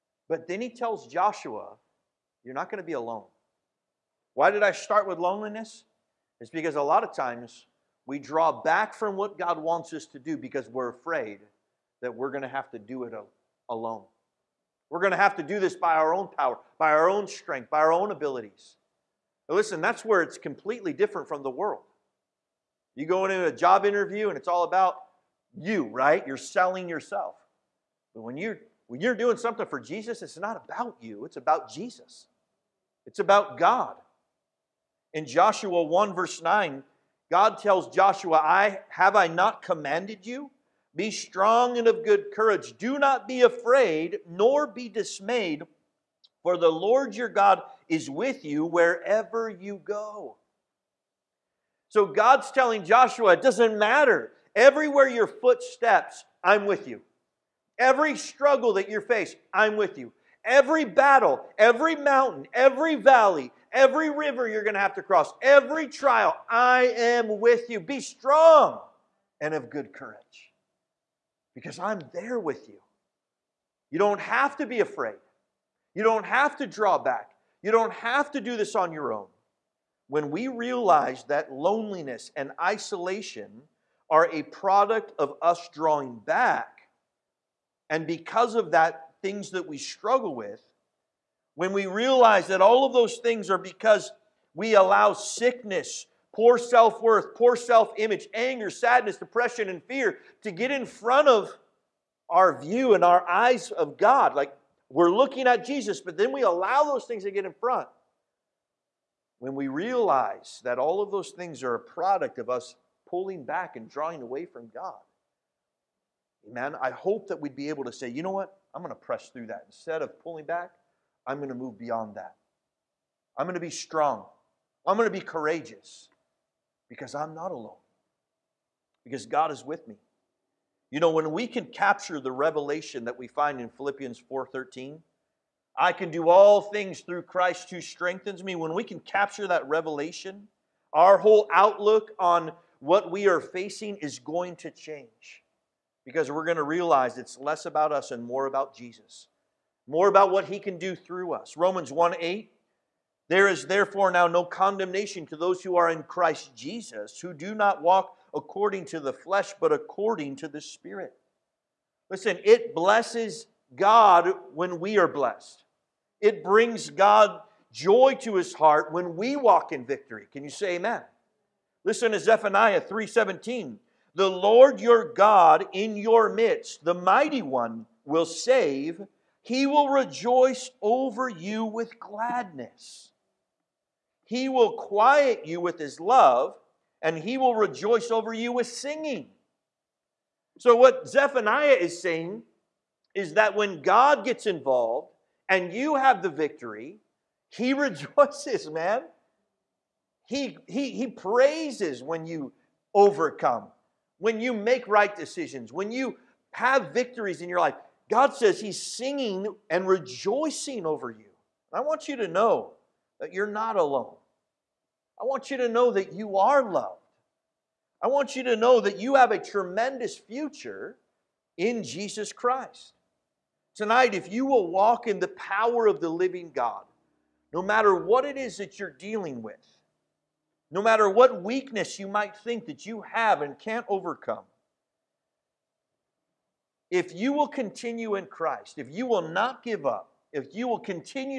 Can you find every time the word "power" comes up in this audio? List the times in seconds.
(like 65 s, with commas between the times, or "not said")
16 s, 225 s.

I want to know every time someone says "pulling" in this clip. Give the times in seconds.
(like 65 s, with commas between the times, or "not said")
113 s, 120 s.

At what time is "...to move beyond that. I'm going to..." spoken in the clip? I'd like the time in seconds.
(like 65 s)
121 s.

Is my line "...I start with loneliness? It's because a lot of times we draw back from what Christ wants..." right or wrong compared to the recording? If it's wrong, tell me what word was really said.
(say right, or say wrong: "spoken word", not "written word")
wrong: "God", not "Christ".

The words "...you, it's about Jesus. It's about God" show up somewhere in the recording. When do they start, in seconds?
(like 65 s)
31 s.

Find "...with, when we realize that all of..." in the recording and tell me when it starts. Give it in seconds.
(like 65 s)
90 s.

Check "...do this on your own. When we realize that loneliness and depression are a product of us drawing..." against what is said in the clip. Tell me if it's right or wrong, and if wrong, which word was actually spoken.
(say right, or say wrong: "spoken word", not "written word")
wrong: "isolation", not "depression".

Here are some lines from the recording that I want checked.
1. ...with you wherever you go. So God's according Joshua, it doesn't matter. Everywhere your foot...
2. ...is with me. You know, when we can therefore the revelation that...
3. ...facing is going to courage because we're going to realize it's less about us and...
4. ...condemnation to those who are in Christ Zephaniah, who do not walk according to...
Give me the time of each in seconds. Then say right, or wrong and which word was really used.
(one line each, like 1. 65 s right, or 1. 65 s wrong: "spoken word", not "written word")
1. 48 s wrong: "telling", not "according"
2. 129 s wrong: "capture", not "therefore"
3. 143 s wrong: "change", not "courage"
4. 154 s wrong: "Jesus", not "Zephaniah".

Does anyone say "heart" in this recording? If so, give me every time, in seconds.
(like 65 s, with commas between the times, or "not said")
168 s.